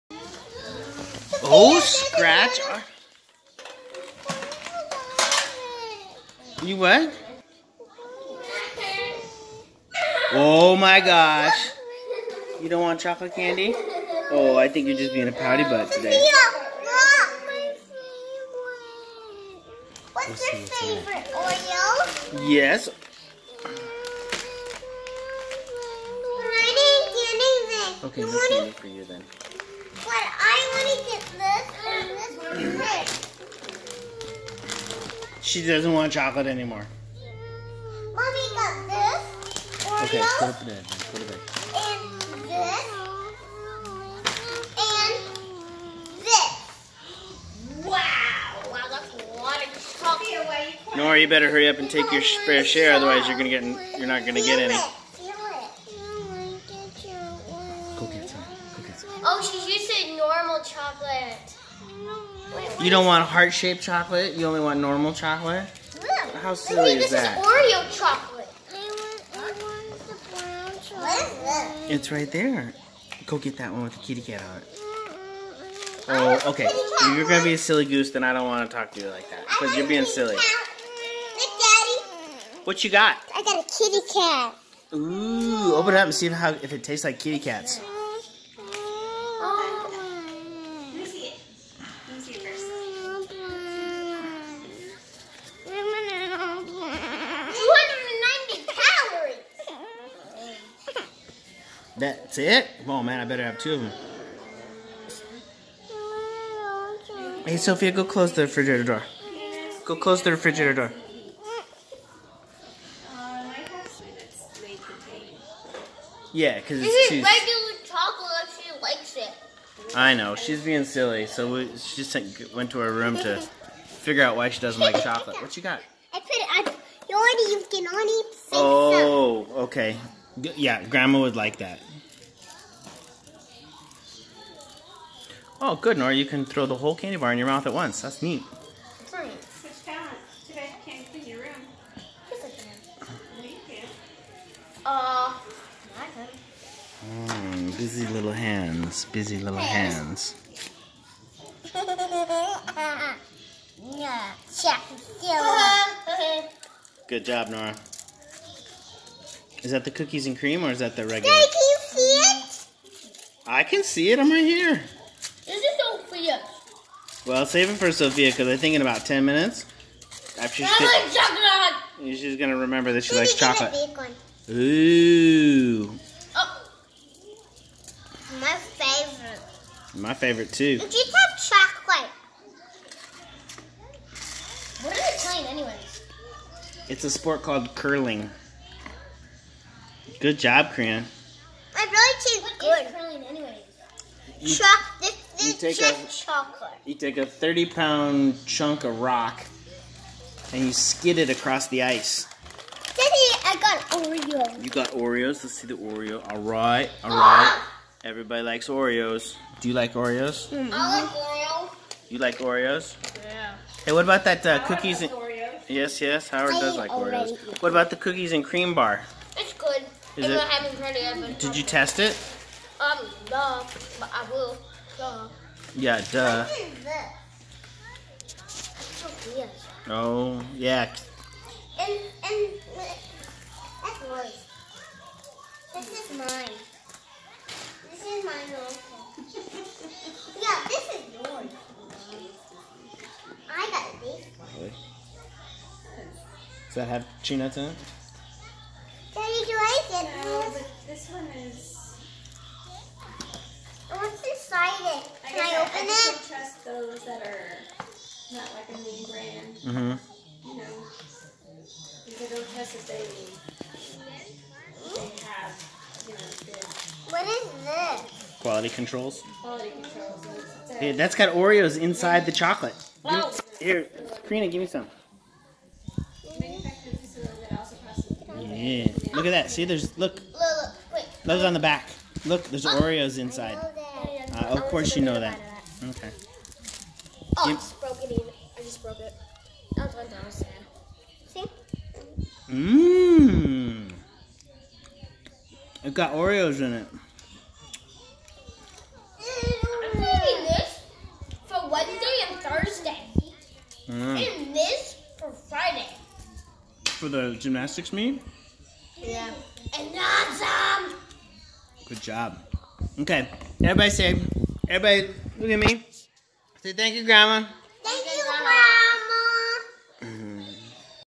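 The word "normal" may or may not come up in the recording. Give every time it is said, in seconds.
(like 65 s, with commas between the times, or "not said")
60 s, 64 s.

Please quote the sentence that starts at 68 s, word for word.
I want, I want the brown chocolate.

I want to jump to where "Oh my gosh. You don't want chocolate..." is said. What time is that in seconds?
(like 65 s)
10 s.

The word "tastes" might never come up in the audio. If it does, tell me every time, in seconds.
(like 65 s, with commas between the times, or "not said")
86 s, 192 s.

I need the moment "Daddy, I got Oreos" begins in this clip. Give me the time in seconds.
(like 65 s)
202 s.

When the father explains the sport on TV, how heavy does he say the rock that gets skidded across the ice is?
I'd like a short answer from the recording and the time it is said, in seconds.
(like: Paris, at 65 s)
30 pounds, at 197 s.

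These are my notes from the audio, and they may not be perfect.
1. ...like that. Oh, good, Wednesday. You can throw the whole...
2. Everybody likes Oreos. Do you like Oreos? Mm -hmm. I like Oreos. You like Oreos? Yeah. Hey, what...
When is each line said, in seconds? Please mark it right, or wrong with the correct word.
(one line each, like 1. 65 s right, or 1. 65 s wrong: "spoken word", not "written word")
1. 131 s wrong: "Nora", not "Wednesday"
2. 208 s right.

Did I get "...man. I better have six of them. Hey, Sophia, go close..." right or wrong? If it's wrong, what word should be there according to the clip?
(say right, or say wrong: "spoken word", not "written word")
wrong: "two", not "six".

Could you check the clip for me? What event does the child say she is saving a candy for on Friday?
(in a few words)
gymnastics meet.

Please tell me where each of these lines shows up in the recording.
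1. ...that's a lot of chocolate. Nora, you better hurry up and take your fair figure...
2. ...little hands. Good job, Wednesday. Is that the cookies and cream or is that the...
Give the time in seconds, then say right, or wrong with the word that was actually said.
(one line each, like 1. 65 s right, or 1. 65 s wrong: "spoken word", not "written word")
1. 48 s wrong: "share", not "figure"
2. 149 s wrong: "Nora", not "Wednesday".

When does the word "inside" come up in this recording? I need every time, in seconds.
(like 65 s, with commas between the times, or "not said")
271 s, 283 s.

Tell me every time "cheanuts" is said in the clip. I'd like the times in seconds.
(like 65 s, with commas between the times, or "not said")
247 s.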